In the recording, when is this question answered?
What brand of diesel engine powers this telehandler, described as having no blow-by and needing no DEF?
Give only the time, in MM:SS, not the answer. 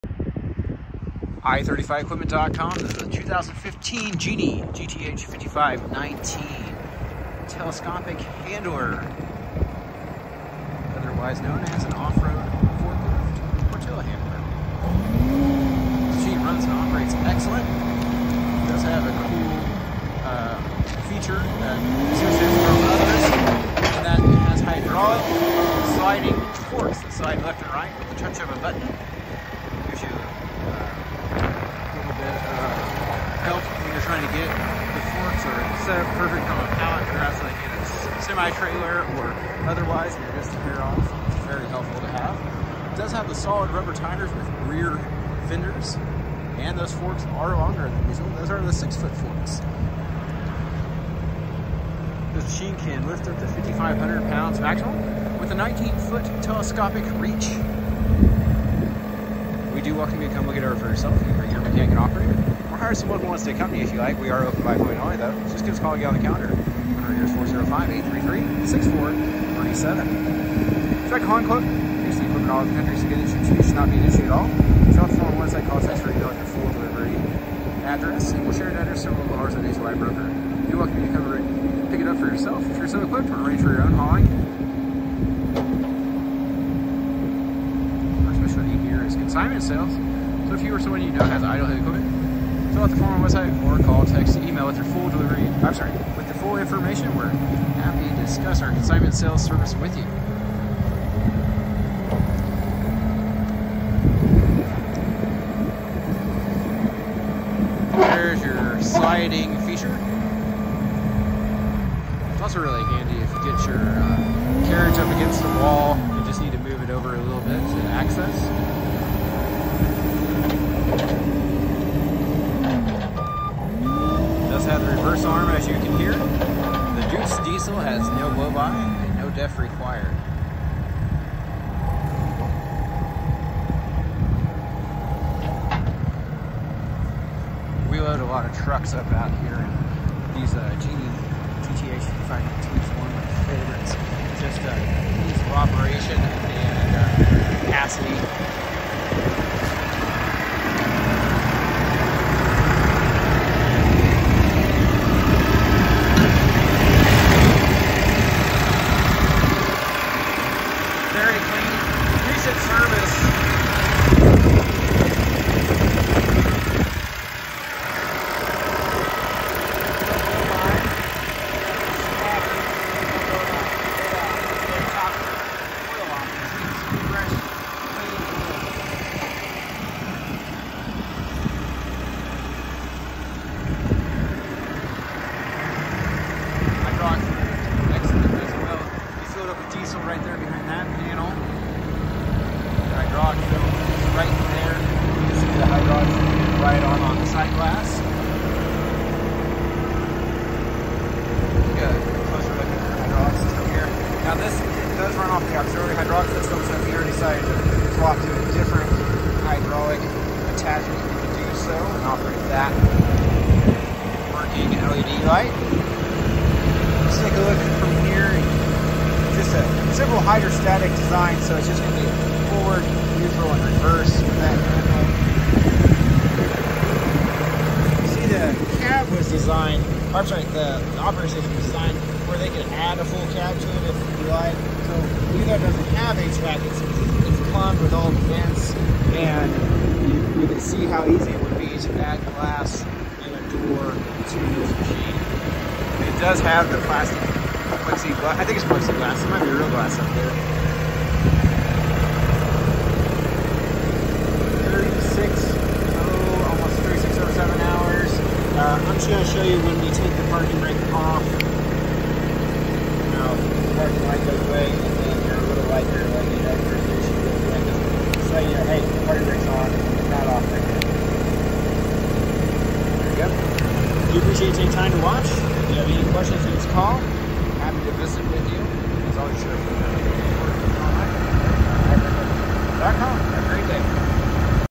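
02:07.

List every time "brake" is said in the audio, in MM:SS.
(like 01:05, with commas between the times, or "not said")
04:20, 04:29.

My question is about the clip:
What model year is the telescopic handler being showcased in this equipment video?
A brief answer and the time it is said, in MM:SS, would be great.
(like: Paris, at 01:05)
2015, at 00:03.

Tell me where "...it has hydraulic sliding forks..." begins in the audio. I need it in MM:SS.
00:24.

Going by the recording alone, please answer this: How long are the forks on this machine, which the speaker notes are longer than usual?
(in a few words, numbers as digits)
6 foot.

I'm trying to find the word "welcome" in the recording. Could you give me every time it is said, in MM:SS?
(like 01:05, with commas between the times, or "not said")
00:59, 01:20.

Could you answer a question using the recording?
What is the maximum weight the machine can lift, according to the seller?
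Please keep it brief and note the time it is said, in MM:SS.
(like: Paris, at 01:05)
5,500 pounds, at 00:53.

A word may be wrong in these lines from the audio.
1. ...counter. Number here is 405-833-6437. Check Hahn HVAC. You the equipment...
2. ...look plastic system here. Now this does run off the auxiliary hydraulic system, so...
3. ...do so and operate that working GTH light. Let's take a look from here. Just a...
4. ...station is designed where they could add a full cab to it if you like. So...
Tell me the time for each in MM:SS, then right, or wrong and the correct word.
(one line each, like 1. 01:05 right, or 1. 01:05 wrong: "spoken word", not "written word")
1. 01:06 wrong: "Club", not "HVAC"
2. 03:22 wrong: "hydraulic", not "plastic"
3. 03:31 wrong: "LED", not "GTH"
4. 03:51 right.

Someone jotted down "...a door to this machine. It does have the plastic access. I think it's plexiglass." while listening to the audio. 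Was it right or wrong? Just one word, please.
wrong.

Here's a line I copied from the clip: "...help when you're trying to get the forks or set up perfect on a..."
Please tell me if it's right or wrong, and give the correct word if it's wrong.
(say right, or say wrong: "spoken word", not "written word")
right.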